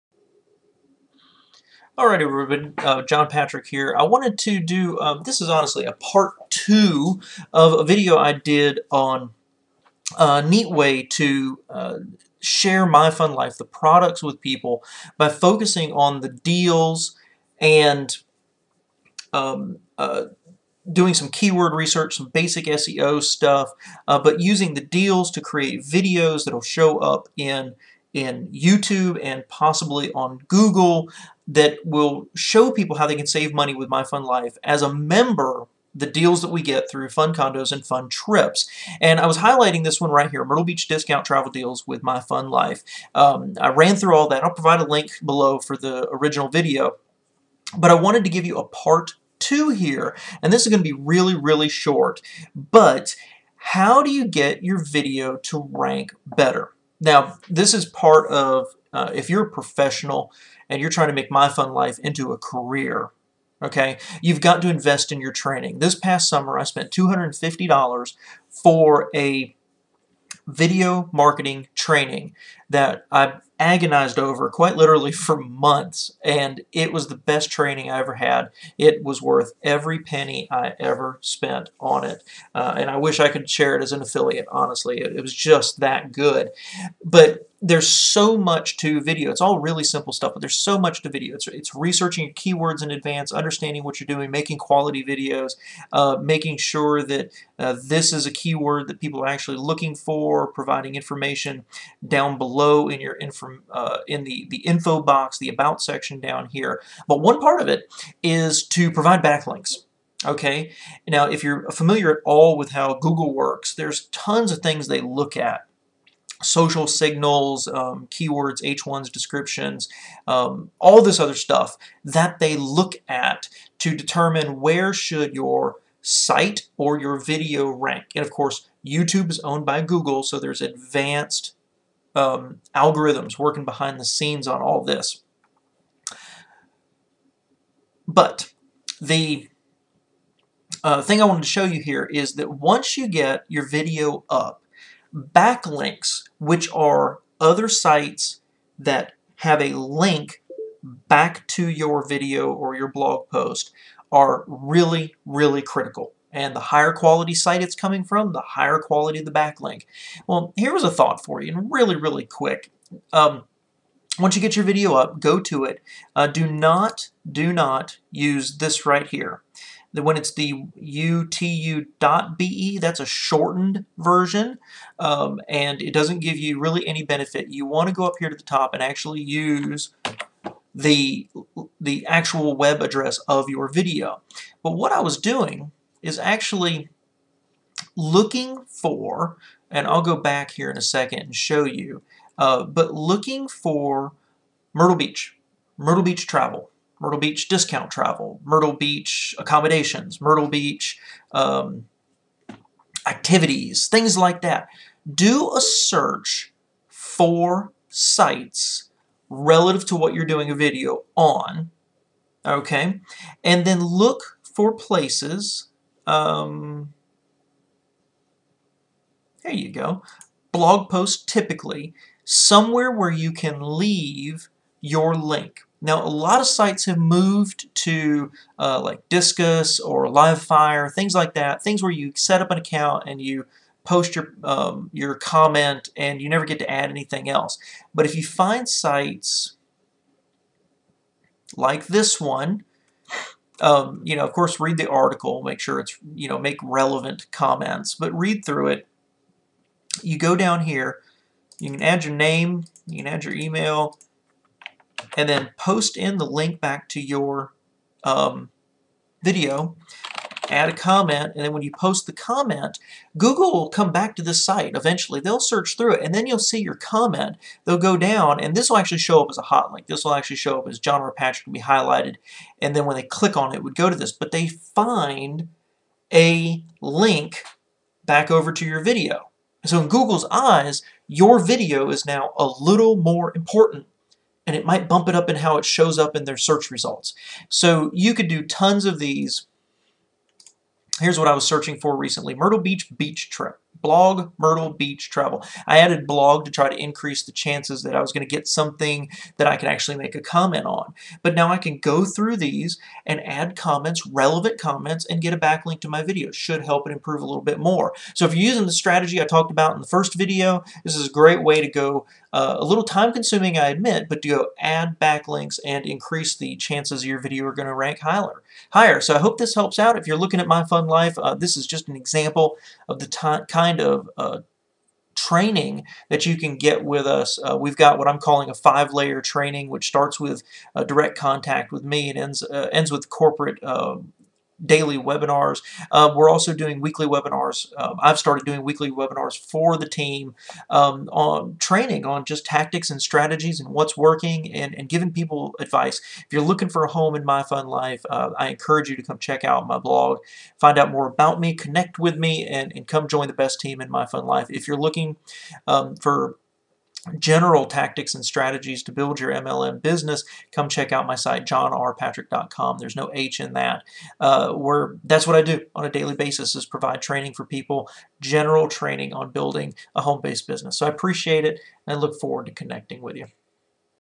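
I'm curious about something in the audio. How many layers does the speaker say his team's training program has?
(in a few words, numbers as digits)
5.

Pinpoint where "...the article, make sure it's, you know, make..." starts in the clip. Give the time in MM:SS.
04:04.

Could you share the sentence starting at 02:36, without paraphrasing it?
And the higher quality site it's coming from, the higher quality the backlink.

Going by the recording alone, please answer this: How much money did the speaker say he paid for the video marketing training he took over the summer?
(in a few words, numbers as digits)
$250.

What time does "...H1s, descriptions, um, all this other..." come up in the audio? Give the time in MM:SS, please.
01:58.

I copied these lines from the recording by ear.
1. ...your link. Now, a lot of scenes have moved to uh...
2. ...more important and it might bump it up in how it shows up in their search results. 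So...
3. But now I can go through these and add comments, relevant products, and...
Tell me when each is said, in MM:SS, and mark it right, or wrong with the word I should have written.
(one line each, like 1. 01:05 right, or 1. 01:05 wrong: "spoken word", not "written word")
1. 03:44 wrong: "sites", not "scenes"
2. 04:42 right
3. 05:01 wrong: "comments", not "products".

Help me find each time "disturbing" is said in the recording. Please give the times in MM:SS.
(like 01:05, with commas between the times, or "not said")
not said.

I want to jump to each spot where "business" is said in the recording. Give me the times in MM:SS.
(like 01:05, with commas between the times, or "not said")
05:59, 06:10.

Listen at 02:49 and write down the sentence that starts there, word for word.
When it's the youtu.be, that's a shortened version, um, and it doesn't give you really any benefit.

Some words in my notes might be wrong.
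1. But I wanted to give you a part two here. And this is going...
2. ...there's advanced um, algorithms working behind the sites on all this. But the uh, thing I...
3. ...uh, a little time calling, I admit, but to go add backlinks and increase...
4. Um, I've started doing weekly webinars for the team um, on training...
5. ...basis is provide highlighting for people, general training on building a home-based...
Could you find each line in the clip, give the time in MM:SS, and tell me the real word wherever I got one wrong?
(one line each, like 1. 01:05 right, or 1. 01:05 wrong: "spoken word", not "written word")
1. 00:47 right
2. 02:10 wrong: "scenes", not "sites"
3. 05:12 wrong: "consuming", not "calling"
4. 05:37 right
5. 06:06 wrong: "training", not "highlighting".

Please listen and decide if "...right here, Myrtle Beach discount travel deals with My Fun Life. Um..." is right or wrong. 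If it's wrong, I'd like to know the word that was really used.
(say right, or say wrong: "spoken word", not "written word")
right.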